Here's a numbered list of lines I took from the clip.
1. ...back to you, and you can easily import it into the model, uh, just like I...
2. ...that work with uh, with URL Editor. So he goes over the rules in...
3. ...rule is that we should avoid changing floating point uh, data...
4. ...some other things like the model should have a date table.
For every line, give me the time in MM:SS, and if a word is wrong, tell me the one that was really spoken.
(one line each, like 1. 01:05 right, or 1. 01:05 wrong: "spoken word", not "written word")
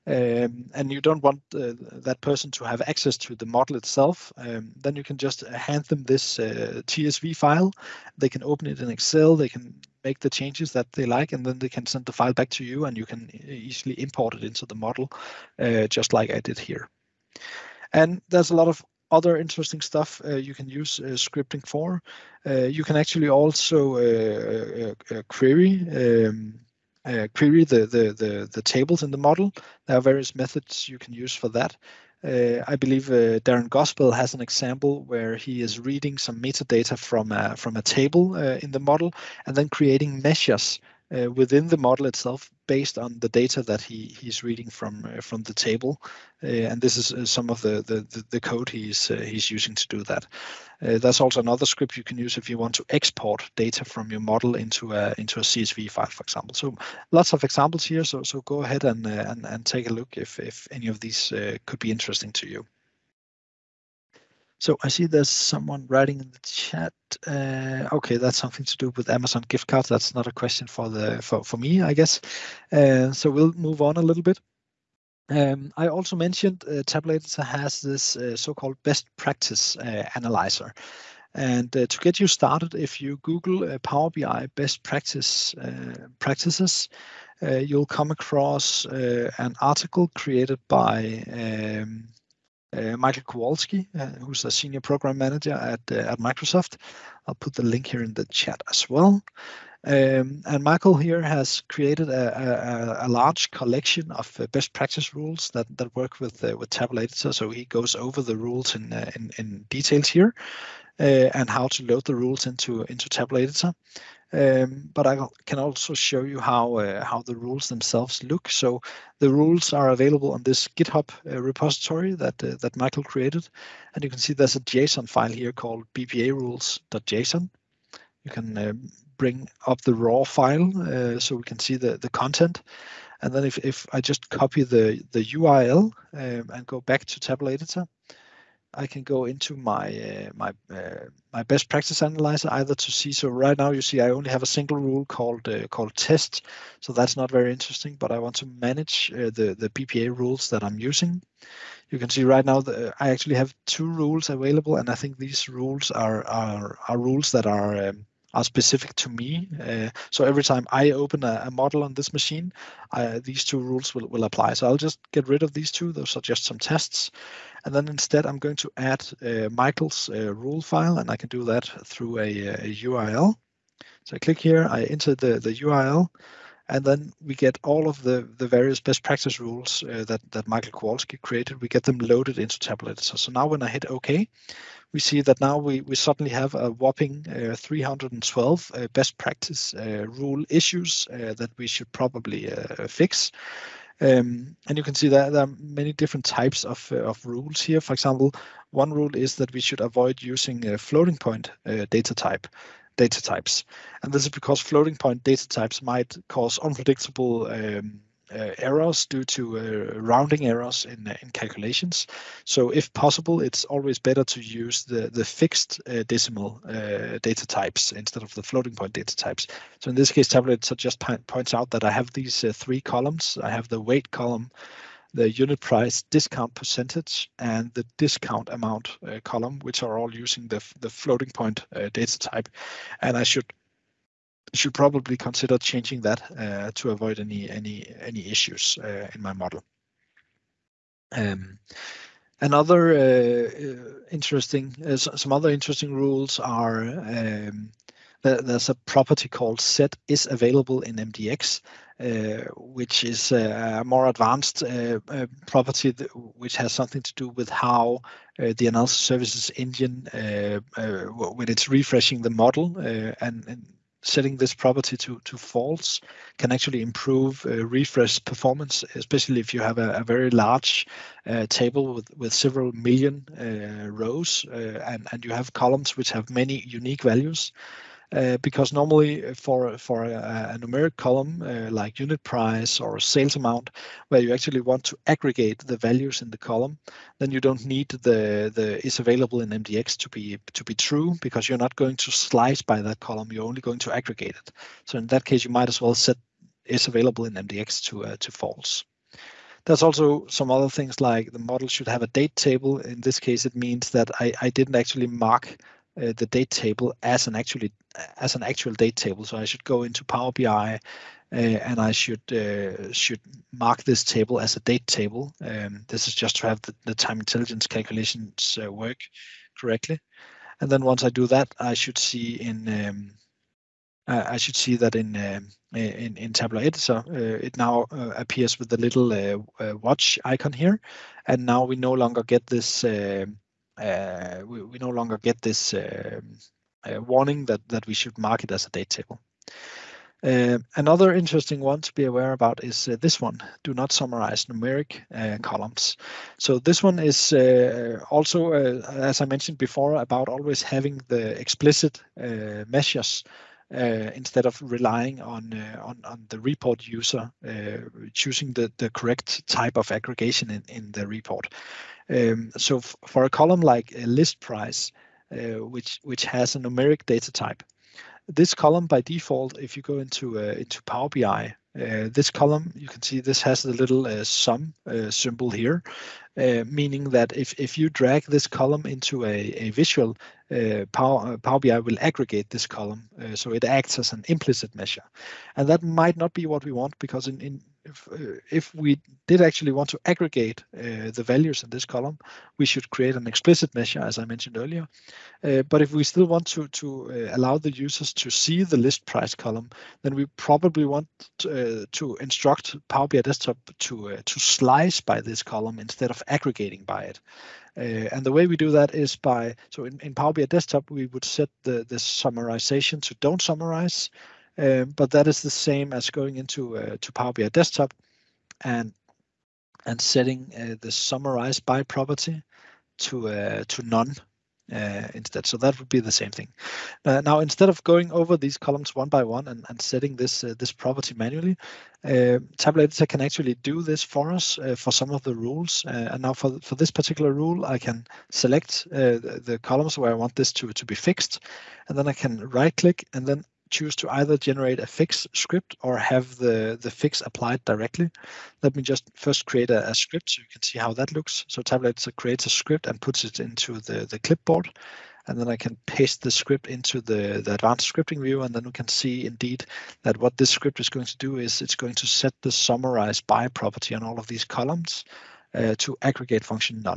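1. 00:12 right
2. 01:45 wrong: "Tabular", not "URL"
3. 03:18 wrong: "using", not "changing"
4. 05:00 right.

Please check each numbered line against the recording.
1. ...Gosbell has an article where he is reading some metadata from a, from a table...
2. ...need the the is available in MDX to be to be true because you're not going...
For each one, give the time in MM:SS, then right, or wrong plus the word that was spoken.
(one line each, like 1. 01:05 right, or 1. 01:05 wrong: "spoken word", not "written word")
1. 00:33 wrong: "example", not "article"
2. 04:47 right.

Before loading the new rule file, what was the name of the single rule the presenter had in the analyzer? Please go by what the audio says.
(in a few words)
test.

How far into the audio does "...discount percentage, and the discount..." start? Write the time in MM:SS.
03:46.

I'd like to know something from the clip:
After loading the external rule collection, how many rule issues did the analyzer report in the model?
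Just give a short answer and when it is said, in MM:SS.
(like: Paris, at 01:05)
312, at 03:07.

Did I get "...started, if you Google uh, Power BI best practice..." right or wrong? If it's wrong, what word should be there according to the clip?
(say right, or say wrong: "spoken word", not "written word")
right.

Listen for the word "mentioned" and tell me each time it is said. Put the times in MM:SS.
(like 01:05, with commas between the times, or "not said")
01:16, 05:49, 06:34.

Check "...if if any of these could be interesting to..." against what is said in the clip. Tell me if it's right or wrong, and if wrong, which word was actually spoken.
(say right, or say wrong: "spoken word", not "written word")
right.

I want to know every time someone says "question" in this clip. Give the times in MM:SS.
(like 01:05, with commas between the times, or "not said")
01:10.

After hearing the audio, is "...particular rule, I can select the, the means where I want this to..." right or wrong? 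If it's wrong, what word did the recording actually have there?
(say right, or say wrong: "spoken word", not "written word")
wrong: "columns", not "means".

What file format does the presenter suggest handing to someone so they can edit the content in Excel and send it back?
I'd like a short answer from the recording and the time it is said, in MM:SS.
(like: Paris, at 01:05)
TSV, at 00:06.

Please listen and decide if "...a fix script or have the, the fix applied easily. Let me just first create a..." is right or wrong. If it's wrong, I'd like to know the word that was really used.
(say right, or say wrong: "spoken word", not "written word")
wrong: "directly", not "easily".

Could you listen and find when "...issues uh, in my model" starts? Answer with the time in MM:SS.
03:58.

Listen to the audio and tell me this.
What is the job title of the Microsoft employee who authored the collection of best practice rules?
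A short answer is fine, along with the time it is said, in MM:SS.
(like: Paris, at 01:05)
senior program manager, at 01:34.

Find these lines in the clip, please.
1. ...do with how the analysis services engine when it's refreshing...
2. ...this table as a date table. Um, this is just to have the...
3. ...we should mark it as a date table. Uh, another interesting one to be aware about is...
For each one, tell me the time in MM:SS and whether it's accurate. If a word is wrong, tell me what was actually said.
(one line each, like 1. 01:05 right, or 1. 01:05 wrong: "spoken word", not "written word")
1. 04:17 right
2. 05:13 right
3. 05:37 right.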